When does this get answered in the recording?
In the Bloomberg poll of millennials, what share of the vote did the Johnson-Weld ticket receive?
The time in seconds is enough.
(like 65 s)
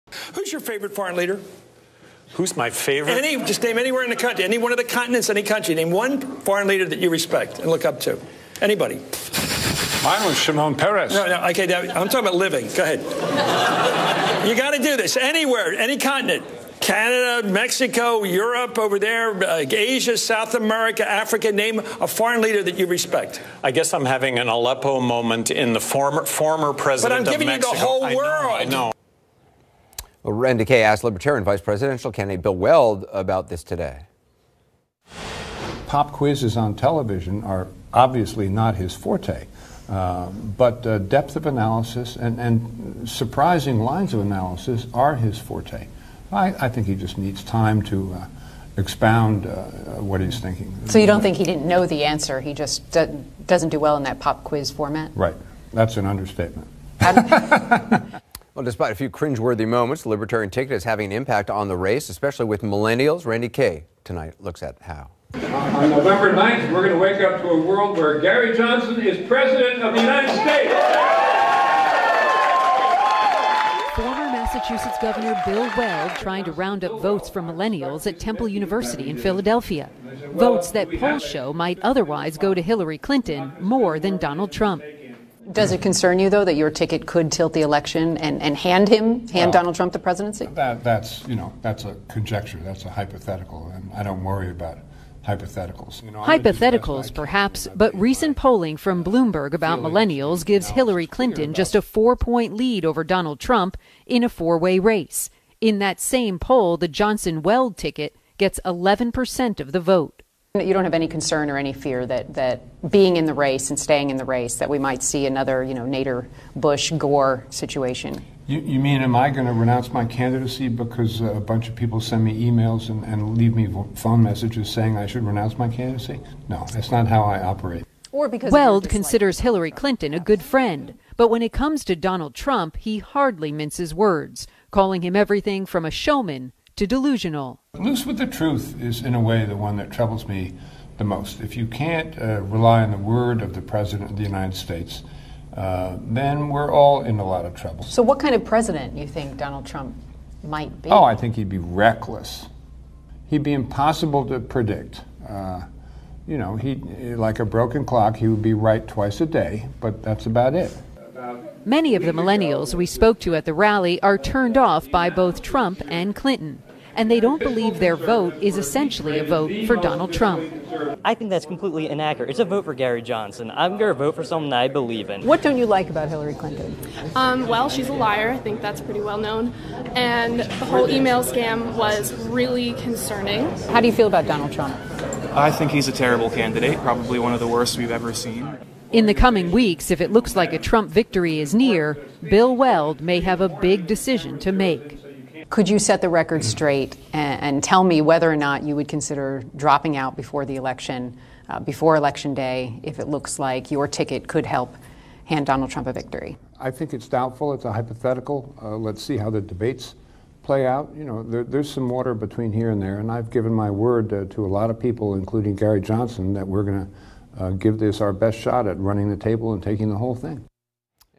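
108 s.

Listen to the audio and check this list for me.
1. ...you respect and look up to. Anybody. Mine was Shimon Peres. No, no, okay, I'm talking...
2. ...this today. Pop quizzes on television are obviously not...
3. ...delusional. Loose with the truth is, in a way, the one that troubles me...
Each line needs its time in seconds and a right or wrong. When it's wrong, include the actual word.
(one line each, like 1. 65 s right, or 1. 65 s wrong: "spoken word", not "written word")
1. 6 s right
2. 33 s right
3. 136 s right.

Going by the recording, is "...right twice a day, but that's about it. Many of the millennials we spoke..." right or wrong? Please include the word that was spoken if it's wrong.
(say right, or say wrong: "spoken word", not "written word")
right.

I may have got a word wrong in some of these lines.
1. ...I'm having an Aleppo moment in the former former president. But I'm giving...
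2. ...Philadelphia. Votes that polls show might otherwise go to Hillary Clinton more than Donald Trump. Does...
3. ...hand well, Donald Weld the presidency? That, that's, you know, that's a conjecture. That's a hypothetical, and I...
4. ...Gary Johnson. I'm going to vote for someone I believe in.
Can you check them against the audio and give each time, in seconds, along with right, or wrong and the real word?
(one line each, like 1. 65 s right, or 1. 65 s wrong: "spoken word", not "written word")
1. 23 s right
2. 79 s right
3. 89 s wrong: "Trump", not "Weld"
4. 172 s right.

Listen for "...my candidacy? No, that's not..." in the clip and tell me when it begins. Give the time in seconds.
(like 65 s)
125 s.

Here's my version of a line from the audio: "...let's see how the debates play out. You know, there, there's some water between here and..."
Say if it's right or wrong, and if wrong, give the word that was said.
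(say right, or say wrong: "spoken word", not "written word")
right.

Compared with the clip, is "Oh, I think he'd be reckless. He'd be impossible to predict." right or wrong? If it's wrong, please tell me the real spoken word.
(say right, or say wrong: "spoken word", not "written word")
right.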